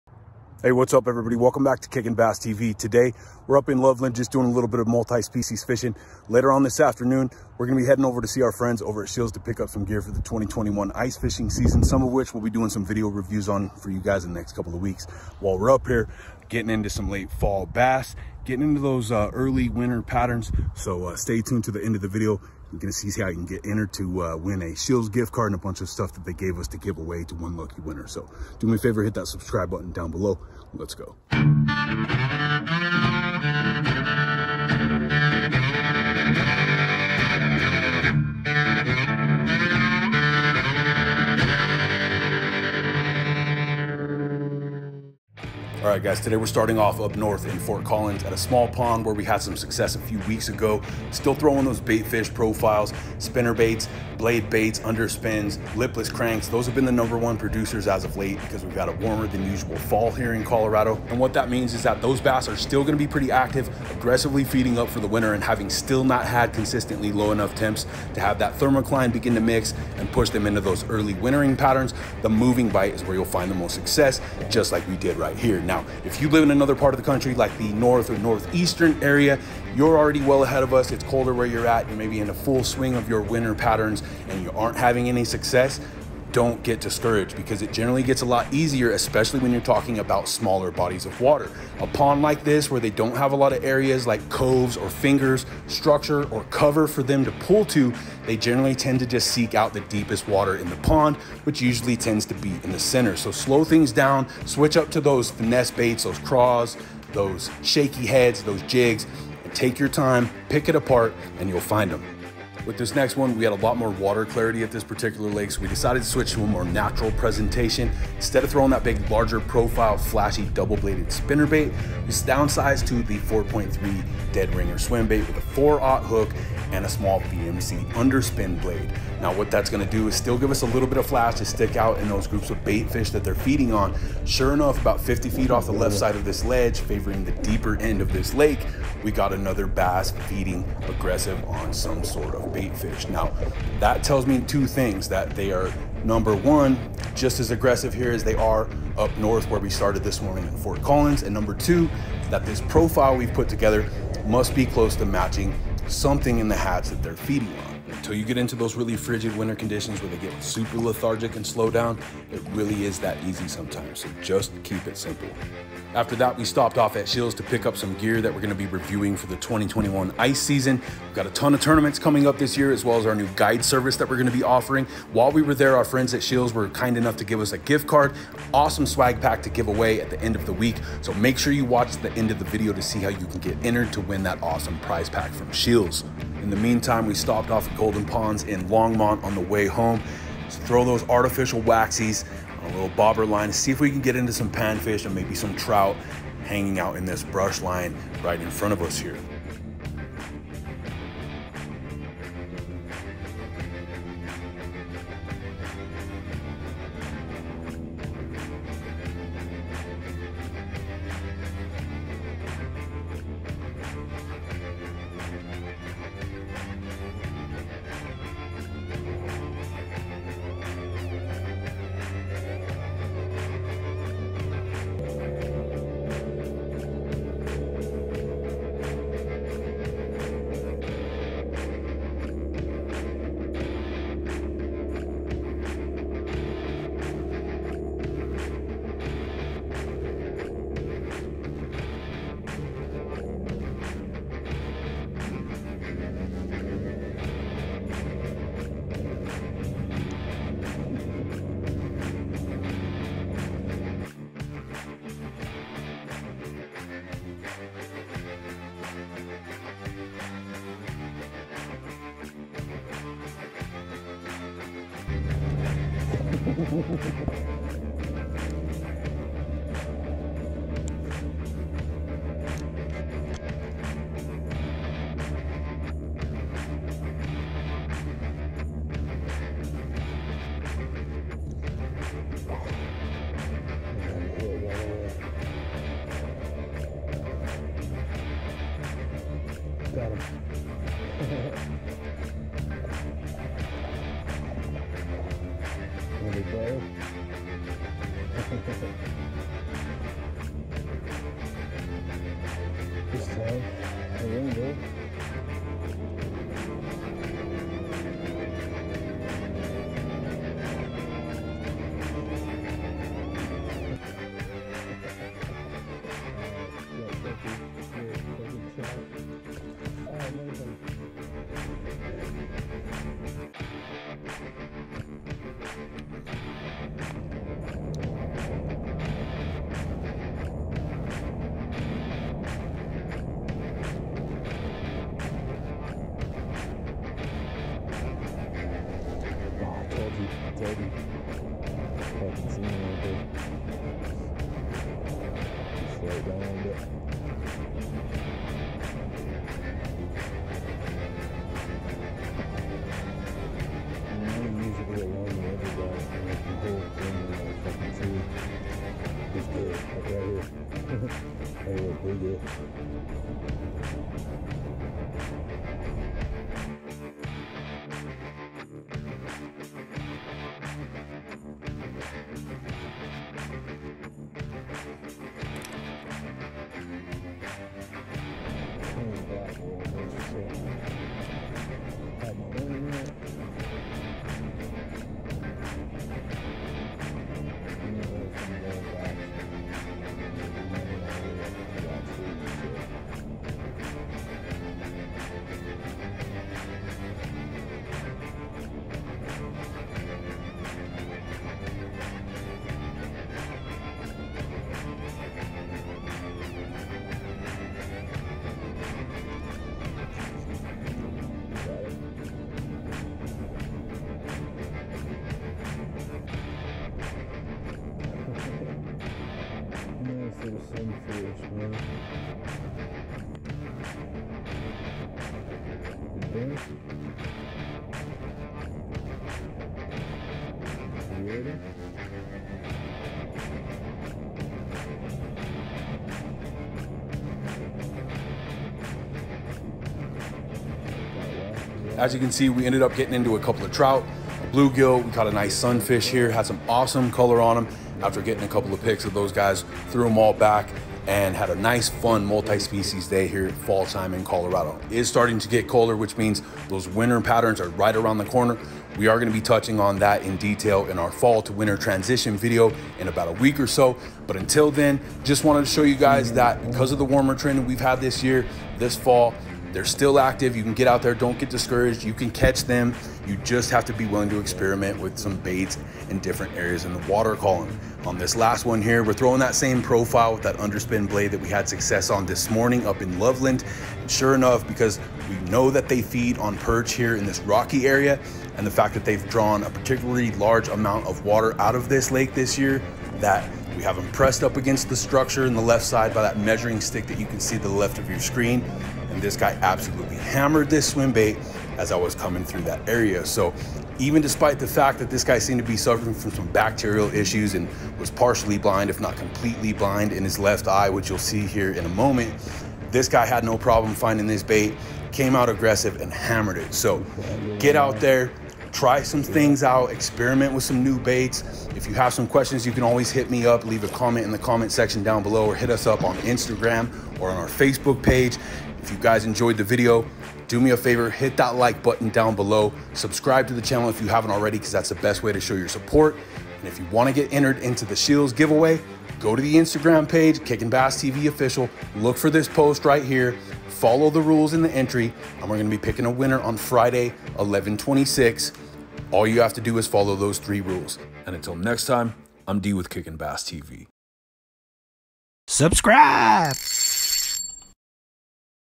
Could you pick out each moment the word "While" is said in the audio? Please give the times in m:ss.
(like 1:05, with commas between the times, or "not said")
0:15, 2:55.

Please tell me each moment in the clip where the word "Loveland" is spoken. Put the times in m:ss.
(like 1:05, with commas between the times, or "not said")
0:03, 8:03.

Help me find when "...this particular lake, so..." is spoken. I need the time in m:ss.
1:54.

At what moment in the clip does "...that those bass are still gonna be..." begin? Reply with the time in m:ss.
1:01.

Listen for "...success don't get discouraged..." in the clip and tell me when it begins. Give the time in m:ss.
1:25.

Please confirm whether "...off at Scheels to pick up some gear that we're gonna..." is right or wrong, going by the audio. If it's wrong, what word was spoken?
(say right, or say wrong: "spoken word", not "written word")
right.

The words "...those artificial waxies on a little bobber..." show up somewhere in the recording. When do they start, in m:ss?
3:10.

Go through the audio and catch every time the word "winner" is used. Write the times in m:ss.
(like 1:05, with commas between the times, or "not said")
0:27, 9:06.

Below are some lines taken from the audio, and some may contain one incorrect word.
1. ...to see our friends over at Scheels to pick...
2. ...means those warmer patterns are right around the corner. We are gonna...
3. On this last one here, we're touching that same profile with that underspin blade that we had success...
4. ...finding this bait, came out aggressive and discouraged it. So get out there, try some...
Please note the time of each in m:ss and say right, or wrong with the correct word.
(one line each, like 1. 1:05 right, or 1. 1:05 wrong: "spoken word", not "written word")
1. 0:08 right
2. 7:36 wrong: "winter", not "warmer"
3. 7:58 wrong: "throwing", not "touching"
4. 8:33 wrong: "hammered", not "discouraged".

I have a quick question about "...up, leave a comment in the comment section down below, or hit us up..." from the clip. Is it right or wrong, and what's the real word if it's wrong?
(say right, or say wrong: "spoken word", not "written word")
right.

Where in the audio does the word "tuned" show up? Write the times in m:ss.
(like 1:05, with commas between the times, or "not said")
0:21.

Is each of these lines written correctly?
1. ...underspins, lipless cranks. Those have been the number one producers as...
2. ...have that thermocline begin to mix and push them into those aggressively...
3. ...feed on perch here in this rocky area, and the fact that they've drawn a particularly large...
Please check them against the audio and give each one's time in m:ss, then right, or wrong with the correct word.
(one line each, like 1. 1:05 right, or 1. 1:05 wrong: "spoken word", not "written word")
1. 0:54 right
2. 1:08 wrong: "early", not "aggressively"
3. 8:06 right.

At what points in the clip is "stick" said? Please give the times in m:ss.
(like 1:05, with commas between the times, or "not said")
2:11, 8:16.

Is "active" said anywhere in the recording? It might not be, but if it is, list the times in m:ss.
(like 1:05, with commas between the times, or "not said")
1:03, 7:50.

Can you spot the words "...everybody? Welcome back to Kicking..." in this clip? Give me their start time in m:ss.
0:01.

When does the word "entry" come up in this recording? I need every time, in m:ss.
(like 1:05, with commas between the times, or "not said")
9:04.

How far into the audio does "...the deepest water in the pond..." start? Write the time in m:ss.
1:39.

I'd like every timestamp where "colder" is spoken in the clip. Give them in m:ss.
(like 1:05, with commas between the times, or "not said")
1:21, 7:35.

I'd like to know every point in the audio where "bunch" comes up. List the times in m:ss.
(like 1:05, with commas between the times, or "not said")
0:25.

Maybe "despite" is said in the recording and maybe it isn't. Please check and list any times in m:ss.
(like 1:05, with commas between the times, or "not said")
8:24.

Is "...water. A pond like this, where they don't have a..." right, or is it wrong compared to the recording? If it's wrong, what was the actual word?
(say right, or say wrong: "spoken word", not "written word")
right.